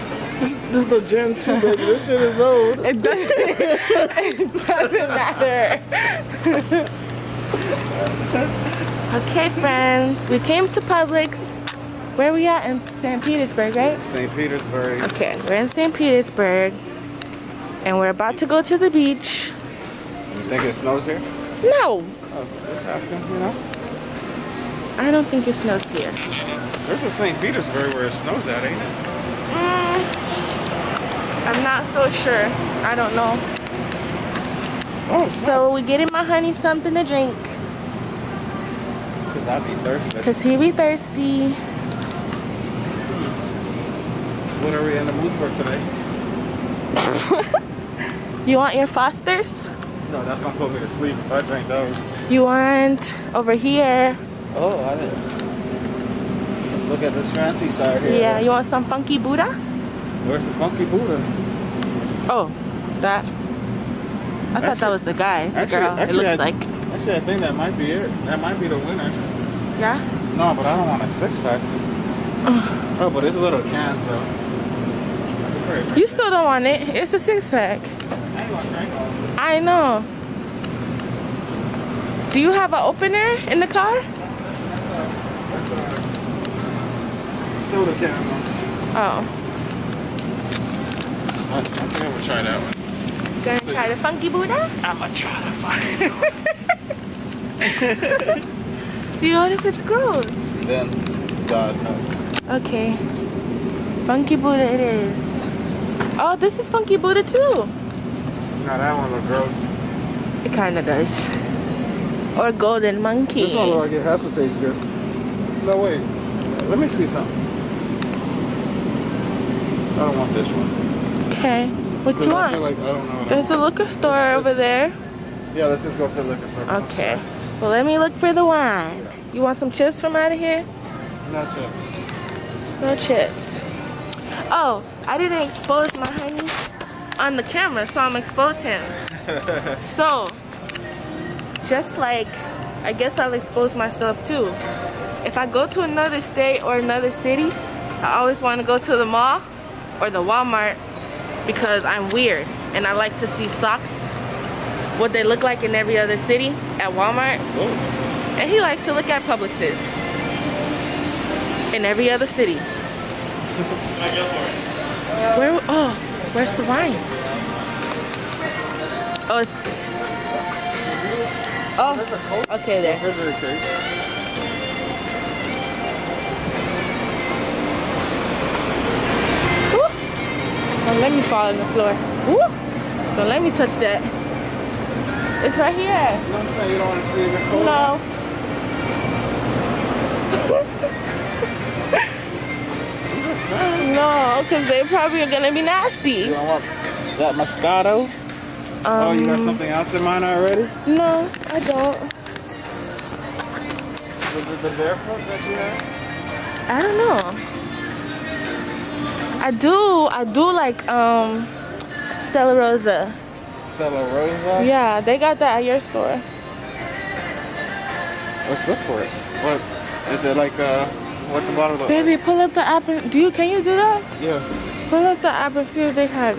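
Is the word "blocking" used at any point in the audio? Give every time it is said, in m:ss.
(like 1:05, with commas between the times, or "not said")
not said.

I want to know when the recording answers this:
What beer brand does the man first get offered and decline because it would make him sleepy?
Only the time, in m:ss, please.
0:48.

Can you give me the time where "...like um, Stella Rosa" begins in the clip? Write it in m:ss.
3:30.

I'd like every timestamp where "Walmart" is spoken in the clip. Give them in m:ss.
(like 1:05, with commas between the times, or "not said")
2:30, 2:36.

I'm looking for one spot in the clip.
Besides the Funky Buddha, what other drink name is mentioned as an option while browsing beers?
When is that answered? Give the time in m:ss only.
1:52.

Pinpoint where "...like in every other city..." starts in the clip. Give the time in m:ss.
2:35.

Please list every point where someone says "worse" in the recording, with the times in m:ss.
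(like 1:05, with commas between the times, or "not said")
not said.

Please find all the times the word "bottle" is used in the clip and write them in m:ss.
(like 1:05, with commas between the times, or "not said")
3:41.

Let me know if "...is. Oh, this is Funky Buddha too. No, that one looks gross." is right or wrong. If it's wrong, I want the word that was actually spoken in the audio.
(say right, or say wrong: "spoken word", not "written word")
right.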